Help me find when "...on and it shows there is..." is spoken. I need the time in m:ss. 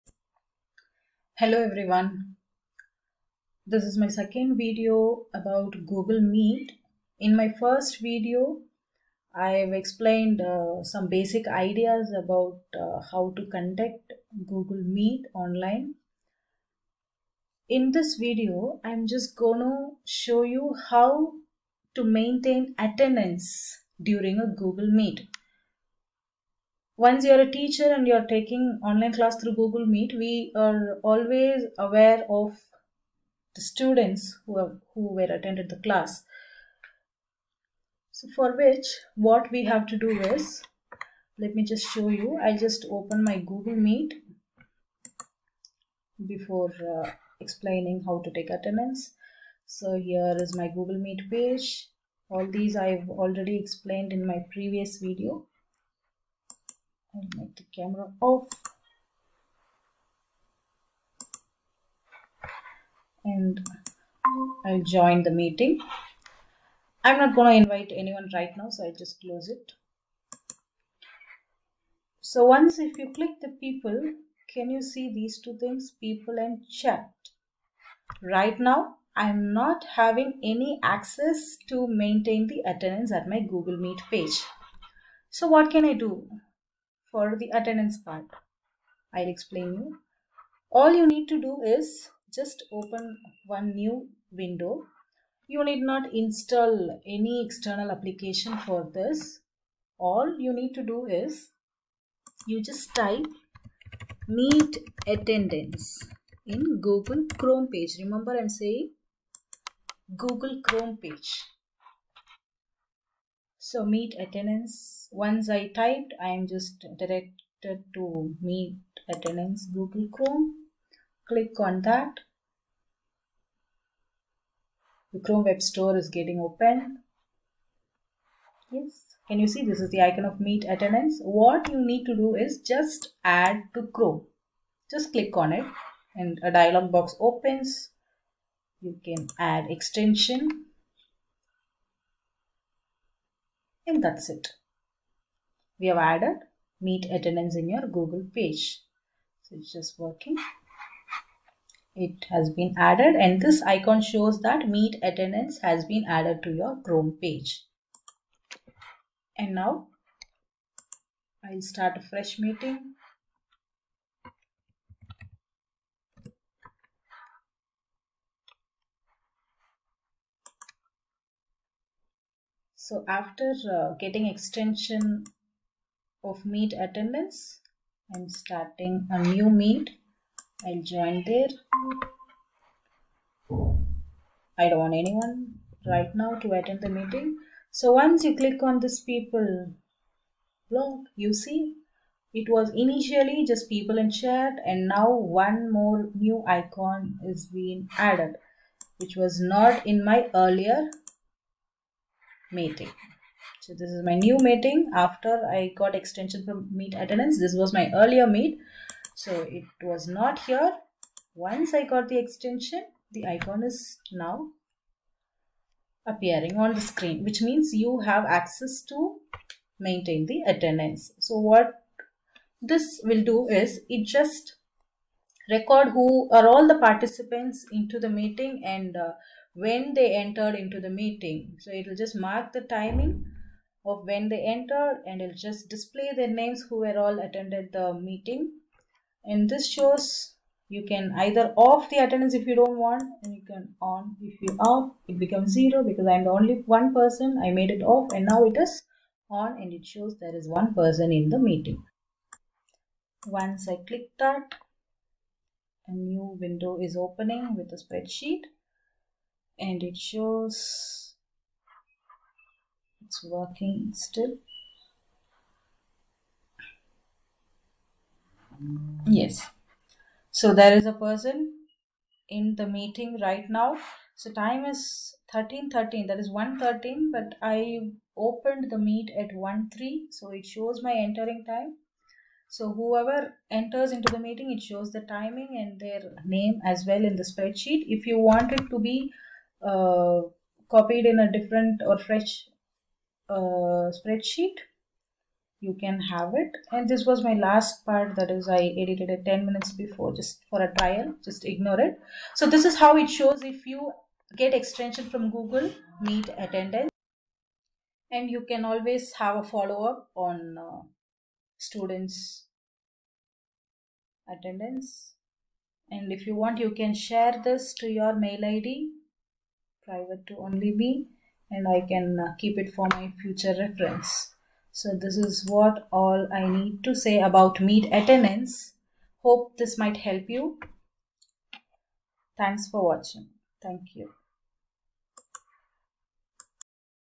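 4:09.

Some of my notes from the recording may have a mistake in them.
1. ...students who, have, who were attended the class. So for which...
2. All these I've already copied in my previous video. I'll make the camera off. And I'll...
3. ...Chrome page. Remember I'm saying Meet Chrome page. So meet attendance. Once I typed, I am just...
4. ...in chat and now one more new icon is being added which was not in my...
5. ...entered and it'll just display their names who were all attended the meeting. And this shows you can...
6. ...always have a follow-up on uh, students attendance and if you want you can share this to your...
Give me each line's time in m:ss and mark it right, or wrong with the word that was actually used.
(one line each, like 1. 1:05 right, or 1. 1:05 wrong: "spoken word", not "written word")
1. 0:33 right
2. 0:52 wrong: "explained", not "copied"
3. 1:47 wrong: "Google", not "Meet"
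4. 3:13 right
5. 3:54 right
6. 5:08 right.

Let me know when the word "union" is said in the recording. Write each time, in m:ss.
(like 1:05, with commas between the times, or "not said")
not said.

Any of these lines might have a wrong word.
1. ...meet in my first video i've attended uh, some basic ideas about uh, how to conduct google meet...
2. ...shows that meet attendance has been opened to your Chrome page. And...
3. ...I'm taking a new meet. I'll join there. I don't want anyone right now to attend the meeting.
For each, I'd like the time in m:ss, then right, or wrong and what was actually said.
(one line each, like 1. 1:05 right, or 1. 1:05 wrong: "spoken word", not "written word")
1. 0:06 wrong: "explained", not "attended"
2. 2:34 wrong: "added", not "opened"
3. 2:58 wrong: "starting", not "taking".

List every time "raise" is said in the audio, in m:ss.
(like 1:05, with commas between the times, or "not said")
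not said.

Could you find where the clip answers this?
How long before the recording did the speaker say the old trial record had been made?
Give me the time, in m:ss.
4:59.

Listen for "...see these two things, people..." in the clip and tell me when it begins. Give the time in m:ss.
1:14.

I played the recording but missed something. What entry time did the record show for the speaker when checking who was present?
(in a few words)
13.13.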